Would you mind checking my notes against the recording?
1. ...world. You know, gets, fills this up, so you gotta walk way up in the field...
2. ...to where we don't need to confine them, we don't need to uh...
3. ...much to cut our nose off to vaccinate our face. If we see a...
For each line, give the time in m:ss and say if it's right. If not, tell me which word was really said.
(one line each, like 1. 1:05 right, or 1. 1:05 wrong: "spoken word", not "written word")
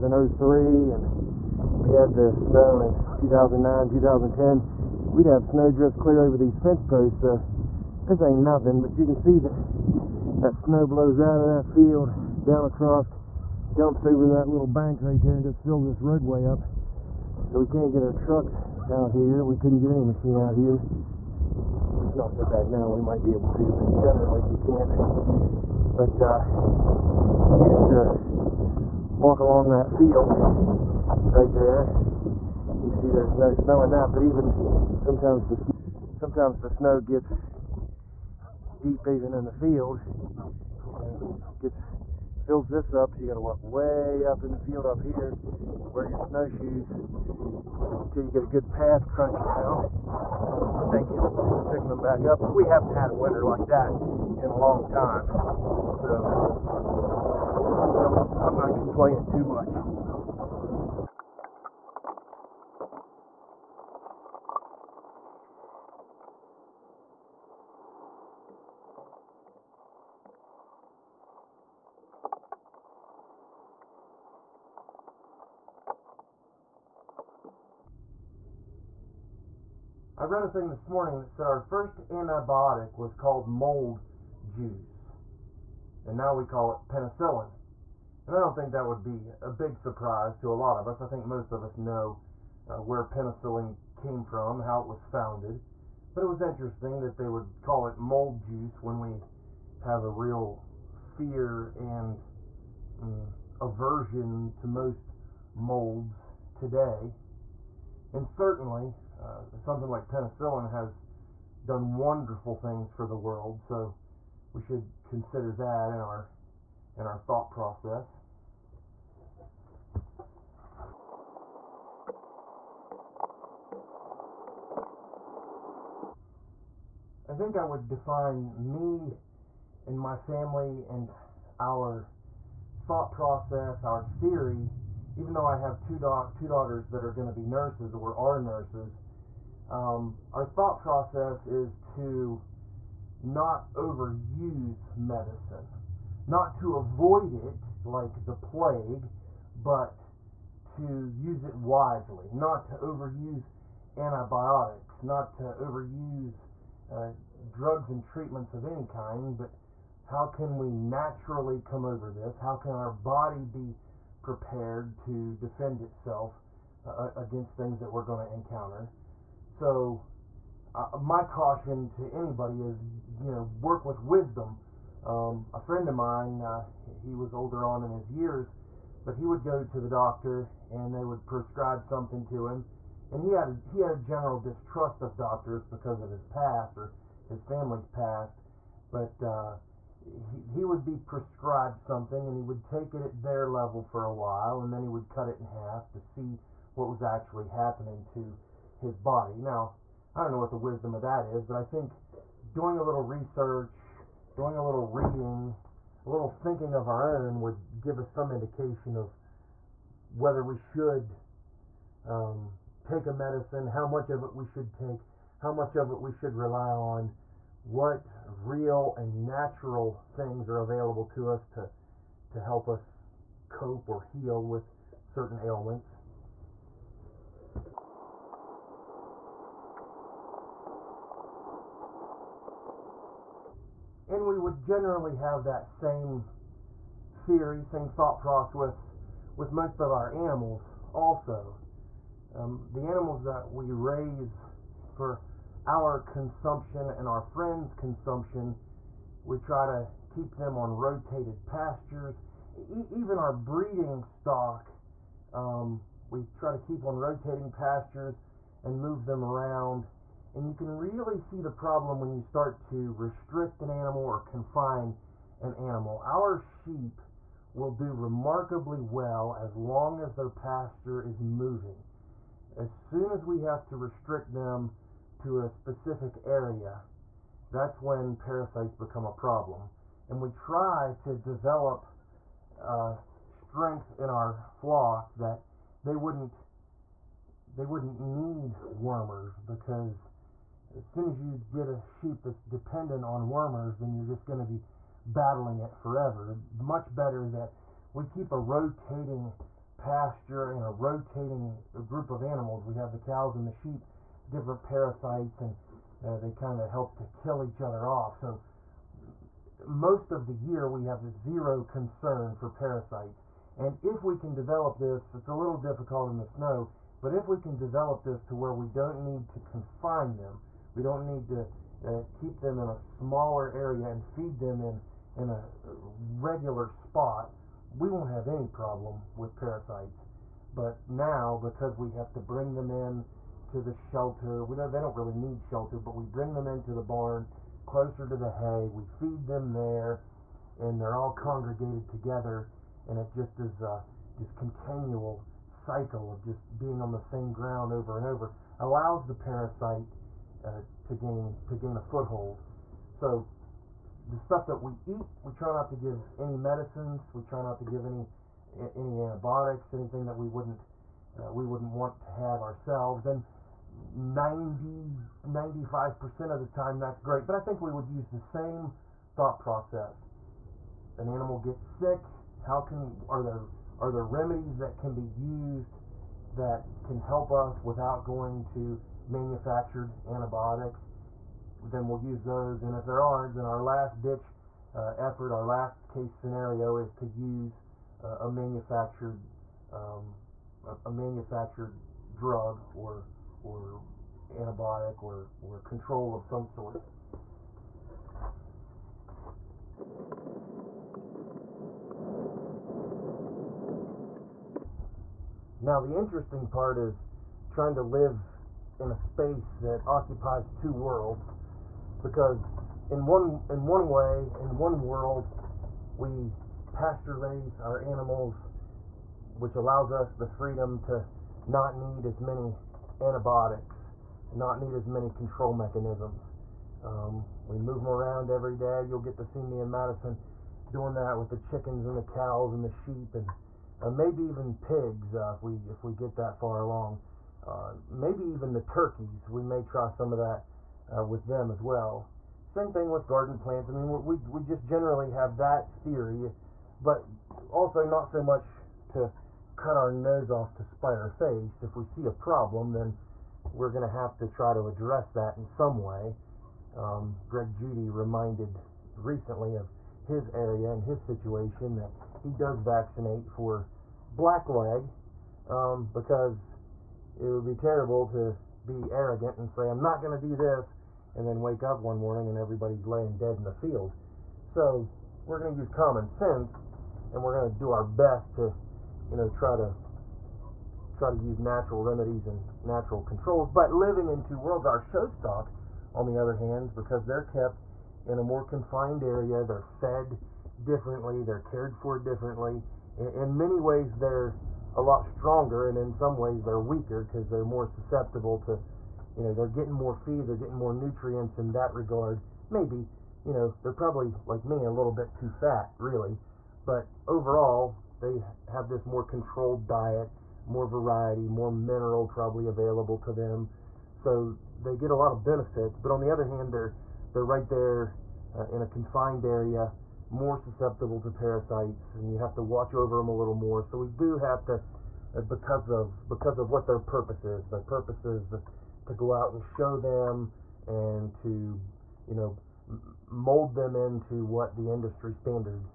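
1. 0:39 wrong: "field", not "world"
2. 5:18 right
3. 7:28 wrong: "spite", not "vaccinate".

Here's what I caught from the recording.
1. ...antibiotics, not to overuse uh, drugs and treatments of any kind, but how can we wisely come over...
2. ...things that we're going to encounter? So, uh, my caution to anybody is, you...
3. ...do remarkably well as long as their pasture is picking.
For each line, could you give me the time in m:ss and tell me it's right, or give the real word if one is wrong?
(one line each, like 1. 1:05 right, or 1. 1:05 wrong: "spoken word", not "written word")
1. 2:33 wrong: "naturally", not "wisely"
2. 2:47 right
3. 4:27 wrong: "moving", not "picking".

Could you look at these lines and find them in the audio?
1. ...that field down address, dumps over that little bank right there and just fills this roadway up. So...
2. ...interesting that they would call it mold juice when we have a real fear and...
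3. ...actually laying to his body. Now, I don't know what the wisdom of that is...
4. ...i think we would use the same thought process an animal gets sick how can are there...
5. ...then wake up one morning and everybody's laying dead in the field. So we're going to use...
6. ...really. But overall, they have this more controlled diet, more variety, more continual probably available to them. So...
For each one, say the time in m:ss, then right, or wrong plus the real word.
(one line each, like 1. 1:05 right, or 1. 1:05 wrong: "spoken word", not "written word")
1. 0:11 wrong: "across", not "address"
2. 1:36 right
3. 3:17 wrong: "happening", not "laying"
4. 6:07 right
5. 7:51 right
6. 8:25 wrong: "mineral", not "continual".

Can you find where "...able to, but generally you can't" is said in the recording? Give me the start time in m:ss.
0:23.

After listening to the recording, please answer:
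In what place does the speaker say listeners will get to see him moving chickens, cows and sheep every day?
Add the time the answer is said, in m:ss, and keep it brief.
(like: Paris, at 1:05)
Madison, at 7:09.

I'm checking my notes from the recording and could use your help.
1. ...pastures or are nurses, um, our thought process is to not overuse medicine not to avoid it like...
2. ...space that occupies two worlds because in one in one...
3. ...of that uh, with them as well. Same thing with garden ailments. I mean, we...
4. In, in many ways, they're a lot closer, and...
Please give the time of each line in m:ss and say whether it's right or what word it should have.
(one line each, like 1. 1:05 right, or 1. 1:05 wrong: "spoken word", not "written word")
1. 2:17 wrong: "nurses", not "pastures"
2. 6:48 right
3. 7:20 wrong: "plants", not "ailments"
4. 8:12 wrong: "stronger", not "closer".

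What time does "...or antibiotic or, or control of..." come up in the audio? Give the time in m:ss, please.
6:33.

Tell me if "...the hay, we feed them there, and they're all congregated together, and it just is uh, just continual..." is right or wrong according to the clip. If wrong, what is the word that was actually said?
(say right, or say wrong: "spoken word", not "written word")
right.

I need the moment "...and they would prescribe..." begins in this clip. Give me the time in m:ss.
3:00.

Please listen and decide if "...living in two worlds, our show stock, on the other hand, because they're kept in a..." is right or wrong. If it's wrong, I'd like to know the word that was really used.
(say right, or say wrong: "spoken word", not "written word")
right.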